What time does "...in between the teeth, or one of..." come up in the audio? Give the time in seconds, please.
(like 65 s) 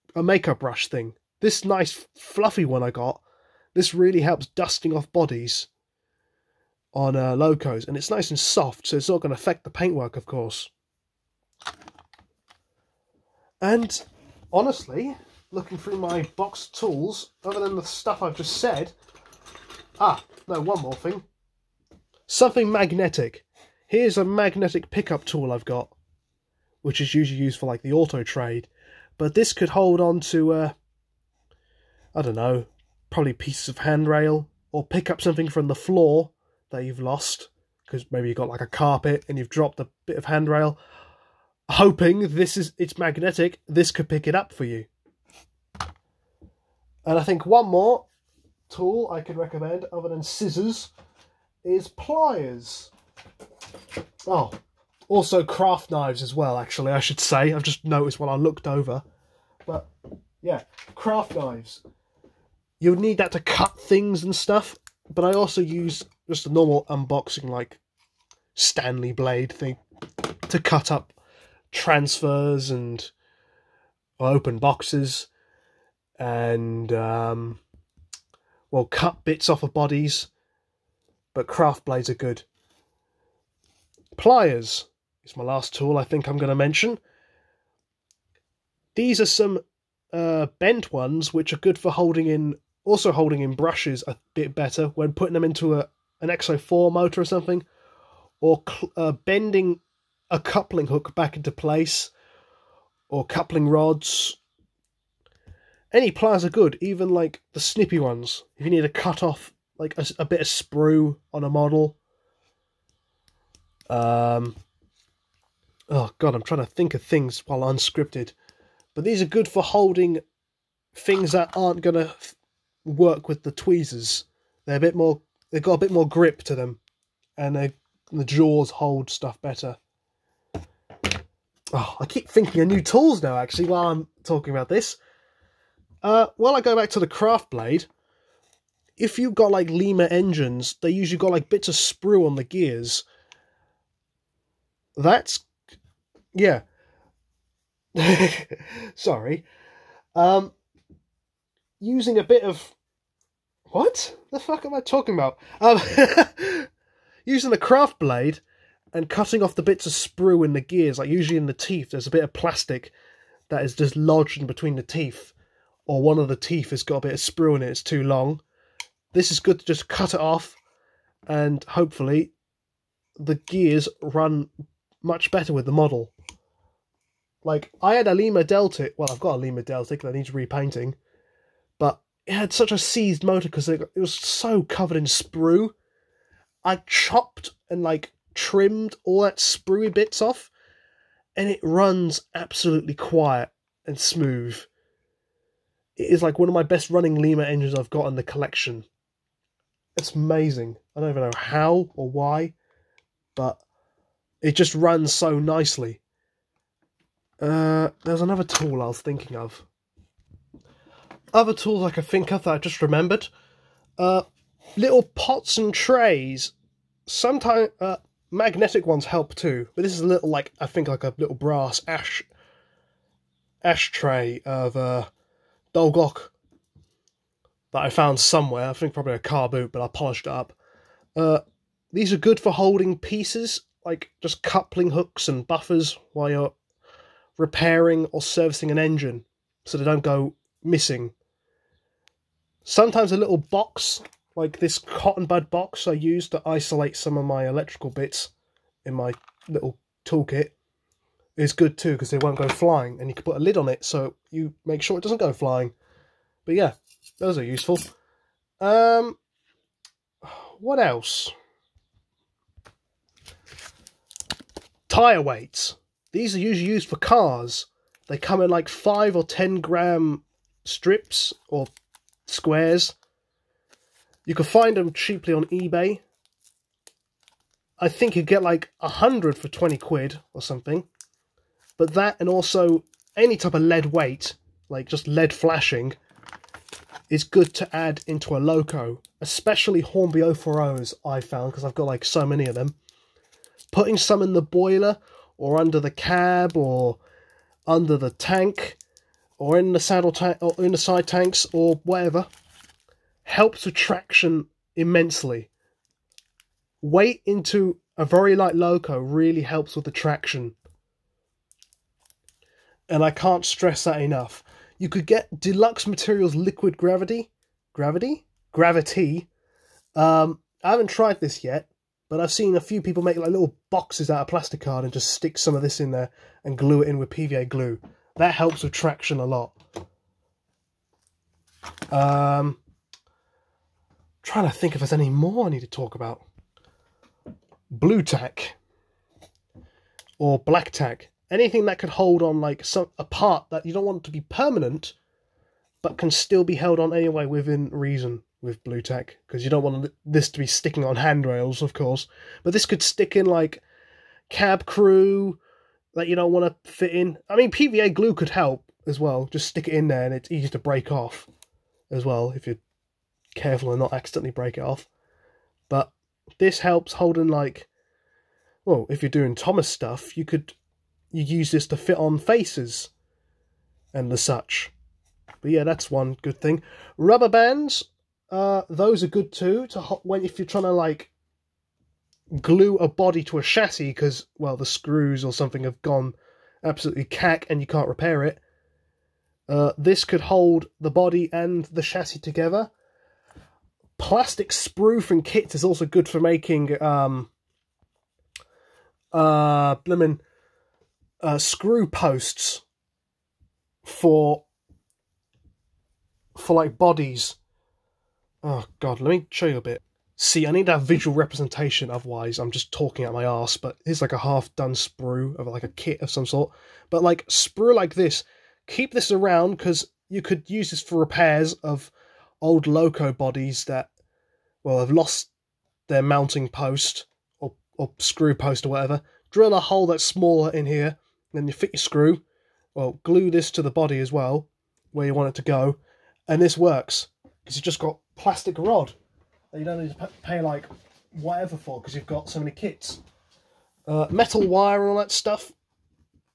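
164 s.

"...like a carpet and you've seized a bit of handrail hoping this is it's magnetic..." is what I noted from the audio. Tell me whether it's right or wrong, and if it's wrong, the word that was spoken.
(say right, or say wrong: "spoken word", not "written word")
wrong: "dropped", not "seized".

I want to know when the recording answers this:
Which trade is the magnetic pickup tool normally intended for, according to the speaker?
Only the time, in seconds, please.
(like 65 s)
27 s.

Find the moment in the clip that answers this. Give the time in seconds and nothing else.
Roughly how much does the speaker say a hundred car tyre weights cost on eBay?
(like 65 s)
279 s.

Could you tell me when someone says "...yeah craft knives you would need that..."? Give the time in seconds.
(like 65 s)
60 s.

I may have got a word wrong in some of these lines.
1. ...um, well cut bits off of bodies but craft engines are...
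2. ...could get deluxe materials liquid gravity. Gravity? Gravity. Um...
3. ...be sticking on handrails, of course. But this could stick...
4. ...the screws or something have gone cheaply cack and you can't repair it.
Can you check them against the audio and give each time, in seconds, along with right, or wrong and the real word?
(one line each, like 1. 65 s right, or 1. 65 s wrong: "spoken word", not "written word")
1. 76 s wrong: "blades", not "engines"
2. 314 s right
3. 350 s right
4. 384 s wrong: "absolutely", not "cheaply".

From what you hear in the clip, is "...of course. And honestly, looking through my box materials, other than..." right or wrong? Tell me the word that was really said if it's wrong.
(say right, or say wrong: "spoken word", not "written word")
wrong: "tools", not "materials".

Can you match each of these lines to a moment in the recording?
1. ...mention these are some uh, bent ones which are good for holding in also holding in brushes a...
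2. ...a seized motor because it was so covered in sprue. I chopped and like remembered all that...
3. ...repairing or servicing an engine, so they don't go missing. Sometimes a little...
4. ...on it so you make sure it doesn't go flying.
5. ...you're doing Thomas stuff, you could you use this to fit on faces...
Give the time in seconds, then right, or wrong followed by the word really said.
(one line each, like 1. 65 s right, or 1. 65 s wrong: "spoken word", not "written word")
1. 86 s right
2. 182 s wrong: "trimmed", not "remembered"
3. 237 s right
4. 253 s right
5. 369 s right.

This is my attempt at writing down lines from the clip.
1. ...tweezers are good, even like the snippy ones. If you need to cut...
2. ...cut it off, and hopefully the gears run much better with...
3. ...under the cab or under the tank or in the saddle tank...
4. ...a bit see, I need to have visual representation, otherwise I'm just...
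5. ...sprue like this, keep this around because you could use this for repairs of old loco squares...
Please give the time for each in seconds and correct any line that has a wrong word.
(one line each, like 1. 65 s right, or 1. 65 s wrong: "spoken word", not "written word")
1. 106 s wrong: "pliers", not "tweezers"
2. 169 s right
3. 295 s right
4. 409 s right
5. 417 s wrong: "bodies", not "squares".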